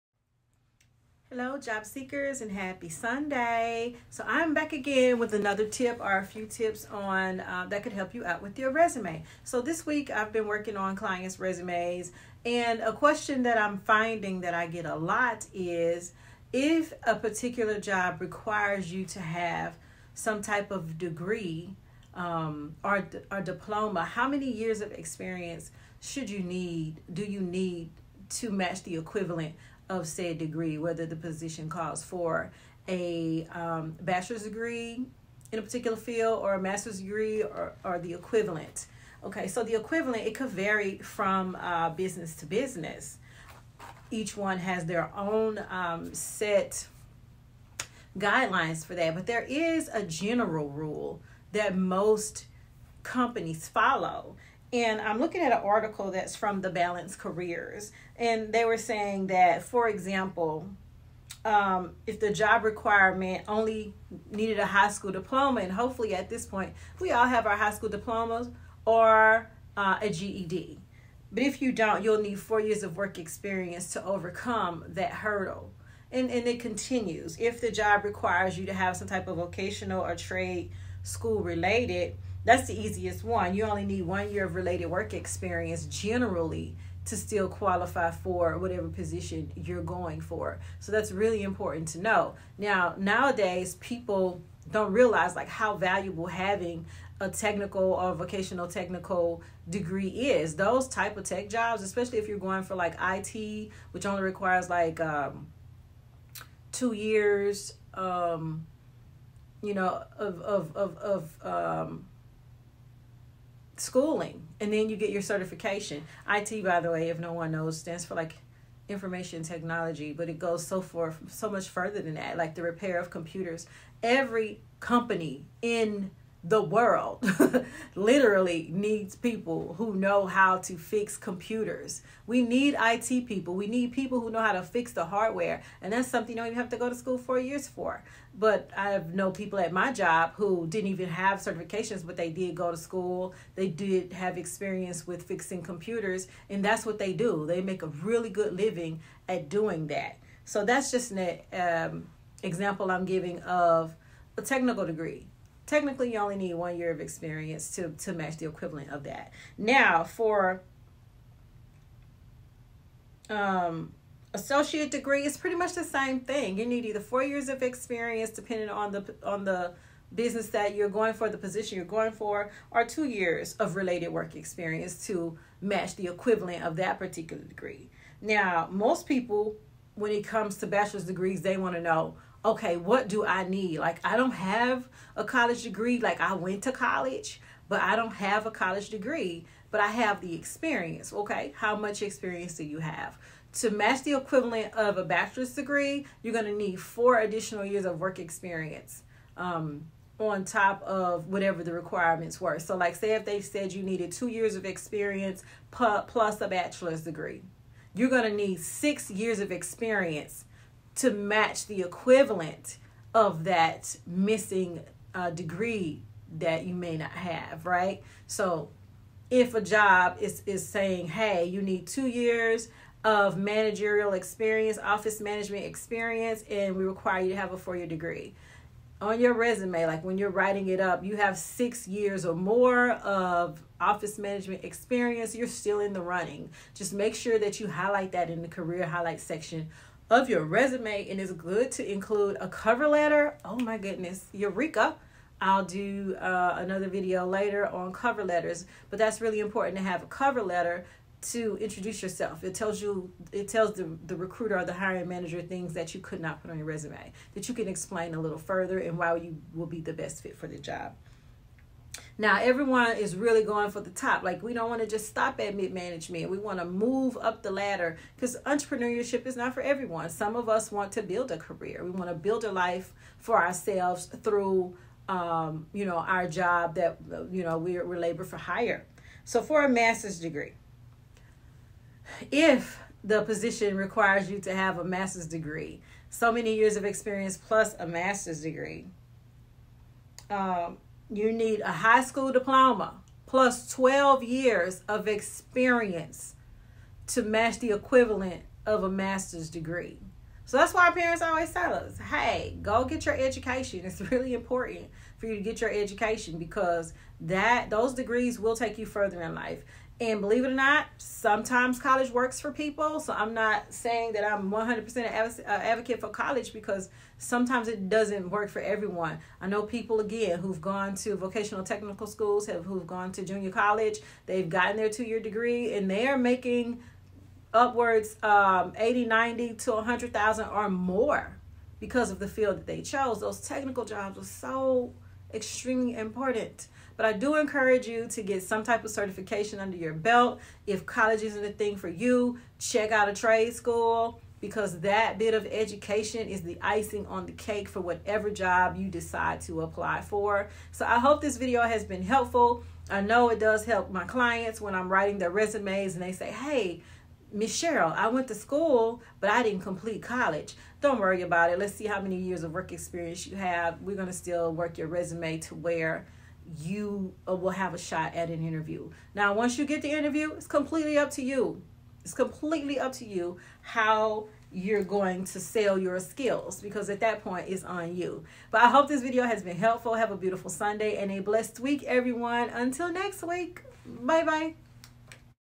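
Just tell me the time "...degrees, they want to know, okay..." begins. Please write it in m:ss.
3:01.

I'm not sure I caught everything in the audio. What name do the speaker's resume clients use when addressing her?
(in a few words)
Miss Cheril.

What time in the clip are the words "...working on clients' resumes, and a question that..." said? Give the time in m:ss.
0:10.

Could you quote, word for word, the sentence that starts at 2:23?
They did have experience with fixing computers.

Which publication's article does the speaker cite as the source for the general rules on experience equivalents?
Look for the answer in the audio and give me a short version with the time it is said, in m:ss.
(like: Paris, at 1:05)
The Balance Careers, at 0:56.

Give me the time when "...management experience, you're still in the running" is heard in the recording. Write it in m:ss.
3:54.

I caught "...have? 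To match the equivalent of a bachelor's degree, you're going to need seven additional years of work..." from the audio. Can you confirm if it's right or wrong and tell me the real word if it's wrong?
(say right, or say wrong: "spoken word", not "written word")
wrong: "four", not "seven".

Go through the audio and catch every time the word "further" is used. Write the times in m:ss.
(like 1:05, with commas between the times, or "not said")
2:01, 4:18, 5:08.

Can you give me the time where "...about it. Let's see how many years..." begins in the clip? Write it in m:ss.
6:01.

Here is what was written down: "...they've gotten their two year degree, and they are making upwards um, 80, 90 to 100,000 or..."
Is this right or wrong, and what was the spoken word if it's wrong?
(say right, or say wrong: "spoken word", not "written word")
right.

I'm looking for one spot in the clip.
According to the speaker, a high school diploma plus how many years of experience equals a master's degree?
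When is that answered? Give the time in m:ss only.
4:53.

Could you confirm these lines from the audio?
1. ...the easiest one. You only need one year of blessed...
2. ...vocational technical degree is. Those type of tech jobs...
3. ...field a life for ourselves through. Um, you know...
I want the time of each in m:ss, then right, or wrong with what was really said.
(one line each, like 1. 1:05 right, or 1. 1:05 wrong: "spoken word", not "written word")
1. 1:22 wrong: "related", not "blessed"
2. 1:38 right
3. 4:32 wrong: "build", not "field".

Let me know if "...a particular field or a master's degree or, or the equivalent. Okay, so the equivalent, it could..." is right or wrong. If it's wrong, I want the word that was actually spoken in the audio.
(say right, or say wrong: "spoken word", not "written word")
right.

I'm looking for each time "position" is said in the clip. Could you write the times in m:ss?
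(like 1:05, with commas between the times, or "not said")
0:31, 1:28, 2:51, 4:43.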